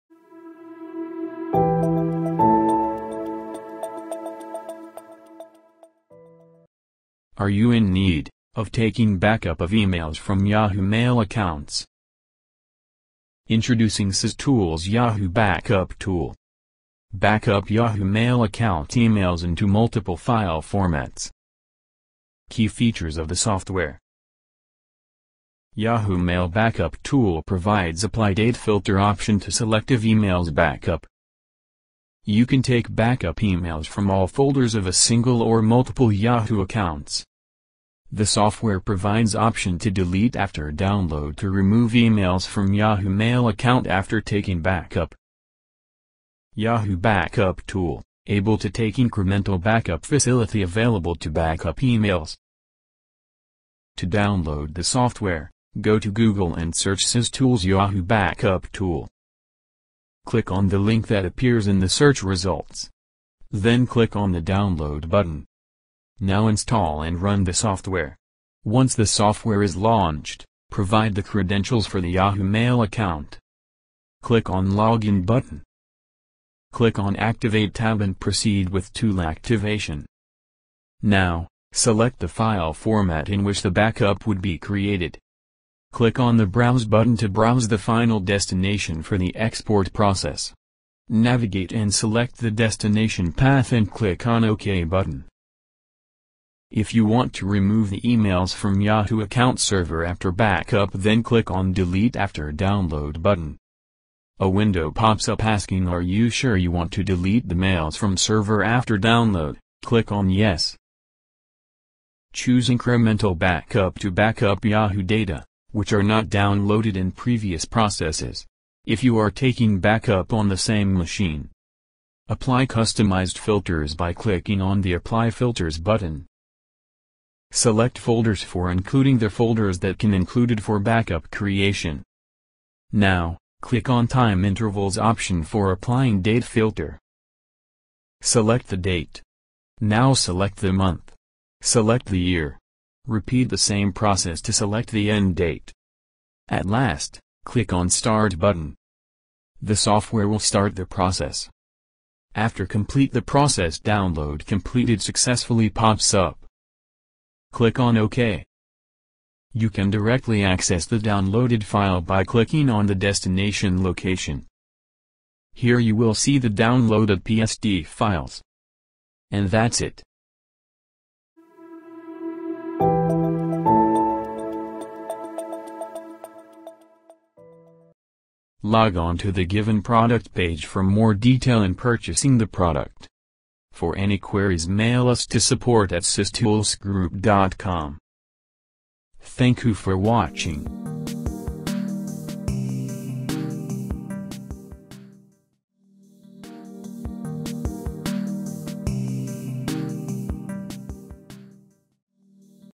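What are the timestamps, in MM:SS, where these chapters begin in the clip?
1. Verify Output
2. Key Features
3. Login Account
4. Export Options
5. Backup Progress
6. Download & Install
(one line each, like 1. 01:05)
1. 02:45
2. 00:23
3. 01:10
4. 01:21
5. 02:29
6. 00:55.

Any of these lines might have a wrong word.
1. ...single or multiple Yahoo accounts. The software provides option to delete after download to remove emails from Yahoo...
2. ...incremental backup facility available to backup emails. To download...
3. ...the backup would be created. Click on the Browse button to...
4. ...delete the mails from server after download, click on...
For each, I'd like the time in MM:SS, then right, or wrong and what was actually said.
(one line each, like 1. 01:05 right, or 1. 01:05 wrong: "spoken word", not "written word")
1. 00:34 right
2. 00:48 right
3. 01:23 right
4. 01:47 right.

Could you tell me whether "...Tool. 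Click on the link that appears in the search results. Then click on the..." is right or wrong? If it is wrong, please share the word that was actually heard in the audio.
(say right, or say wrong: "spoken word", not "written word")
right.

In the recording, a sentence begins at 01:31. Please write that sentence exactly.
Navigate and select the destination path and click on OK button.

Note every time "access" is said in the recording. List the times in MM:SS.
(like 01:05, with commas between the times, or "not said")
02:40.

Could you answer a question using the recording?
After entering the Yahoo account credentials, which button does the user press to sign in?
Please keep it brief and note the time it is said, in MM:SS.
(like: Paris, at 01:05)
Login, at 01:14.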